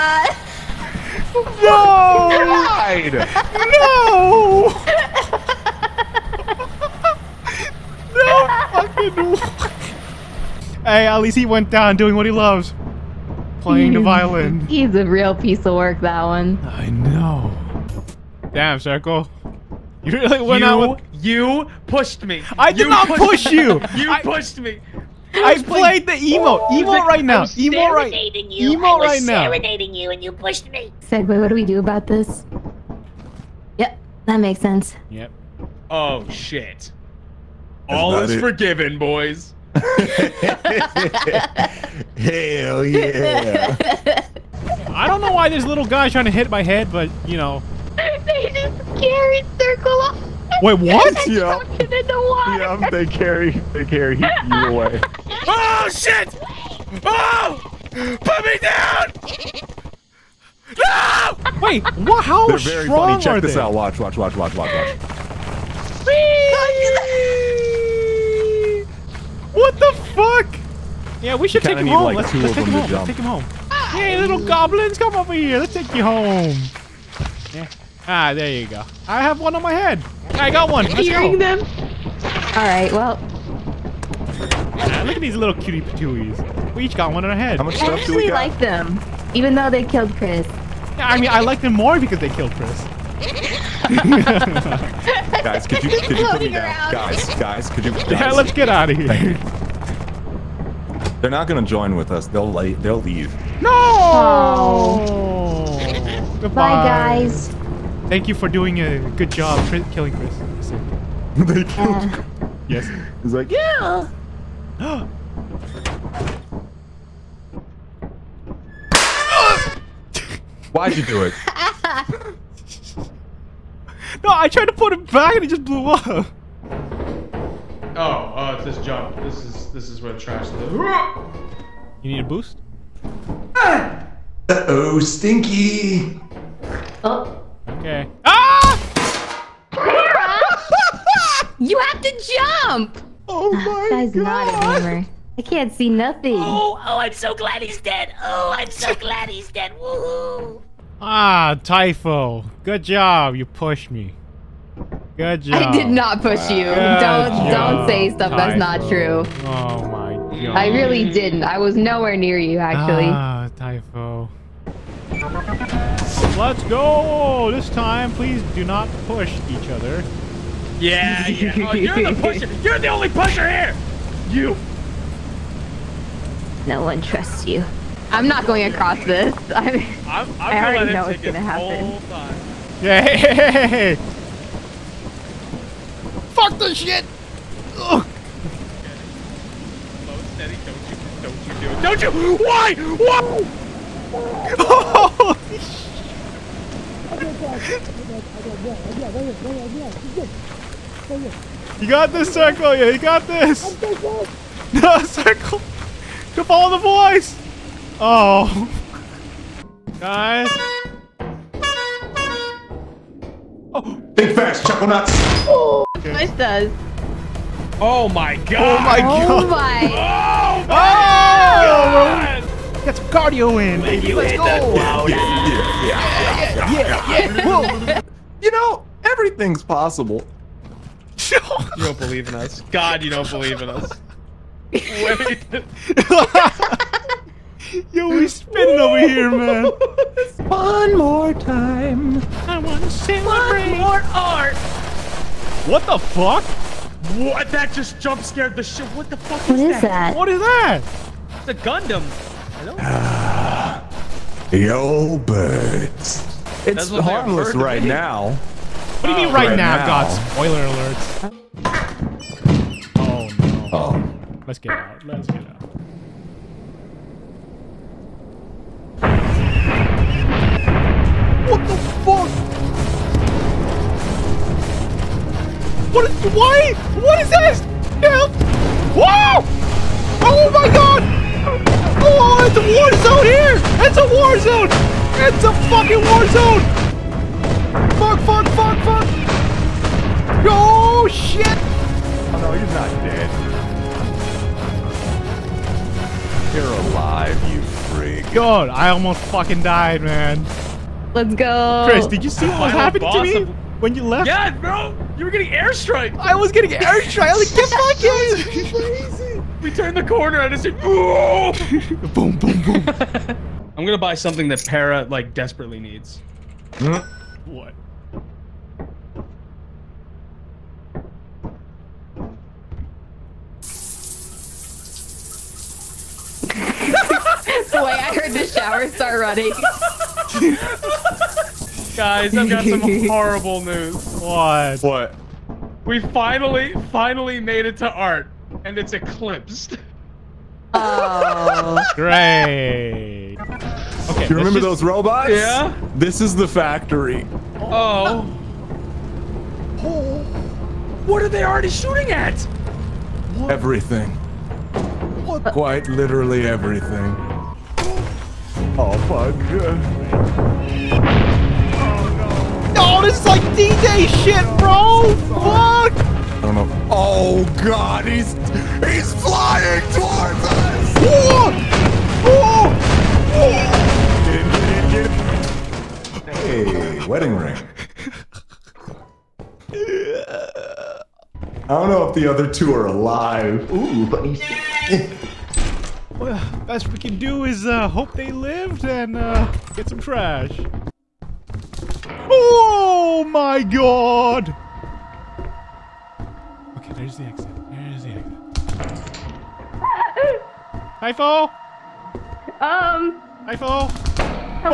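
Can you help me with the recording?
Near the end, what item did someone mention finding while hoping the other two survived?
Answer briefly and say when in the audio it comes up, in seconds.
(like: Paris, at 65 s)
wedding ring, at 377 s.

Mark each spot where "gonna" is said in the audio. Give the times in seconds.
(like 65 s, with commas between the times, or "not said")
101 s, 181 s, 313 s.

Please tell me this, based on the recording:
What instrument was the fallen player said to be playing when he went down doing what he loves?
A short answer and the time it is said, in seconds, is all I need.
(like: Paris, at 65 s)
violin, at 13 s.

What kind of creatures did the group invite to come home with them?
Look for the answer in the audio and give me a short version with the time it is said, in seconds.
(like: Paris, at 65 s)
goblins, at 74 s.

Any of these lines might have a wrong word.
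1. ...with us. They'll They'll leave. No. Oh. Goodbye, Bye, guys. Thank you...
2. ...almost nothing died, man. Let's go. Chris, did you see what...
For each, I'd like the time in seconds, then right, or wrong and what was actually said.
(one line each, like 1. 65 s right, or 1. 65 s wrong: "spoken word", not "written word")
1. 101 s right
2. 298 s wrong: "fucking", not "nothing".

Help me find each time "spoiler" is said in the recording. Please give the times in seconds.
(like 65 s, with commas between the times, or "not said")
260 s.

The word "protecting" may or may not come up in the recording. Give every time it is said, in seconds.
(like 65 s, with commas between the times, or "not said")
not said.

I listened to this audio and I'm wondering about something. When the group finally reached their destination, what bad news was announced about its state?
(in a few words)
It's eclipsed.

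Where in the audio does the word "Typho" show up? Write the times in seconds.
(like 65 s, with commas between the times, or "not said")
151 s, 158 s, 163 s.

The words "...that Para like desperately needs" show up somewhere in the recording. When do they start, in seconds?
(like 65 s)
314 s.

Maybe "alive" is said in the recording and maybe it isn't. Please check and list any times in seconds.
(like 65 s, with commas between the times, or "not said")
296 s, 382 s.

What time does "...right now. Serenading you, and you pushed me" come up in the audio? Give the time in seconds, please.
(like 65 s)
28 s.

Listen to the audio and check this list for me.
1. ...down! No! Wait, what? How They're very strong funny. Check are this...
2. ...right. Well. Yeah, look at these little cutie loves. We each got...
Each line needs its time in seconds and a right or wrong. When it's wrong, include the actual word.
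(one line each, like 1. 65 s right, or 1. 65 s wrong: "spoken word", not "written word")
1. 58 s right
2. 82 s wrong: "patooies", not "loves".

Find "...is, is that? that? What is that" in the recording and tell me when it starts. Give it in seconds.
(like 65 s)
249 s.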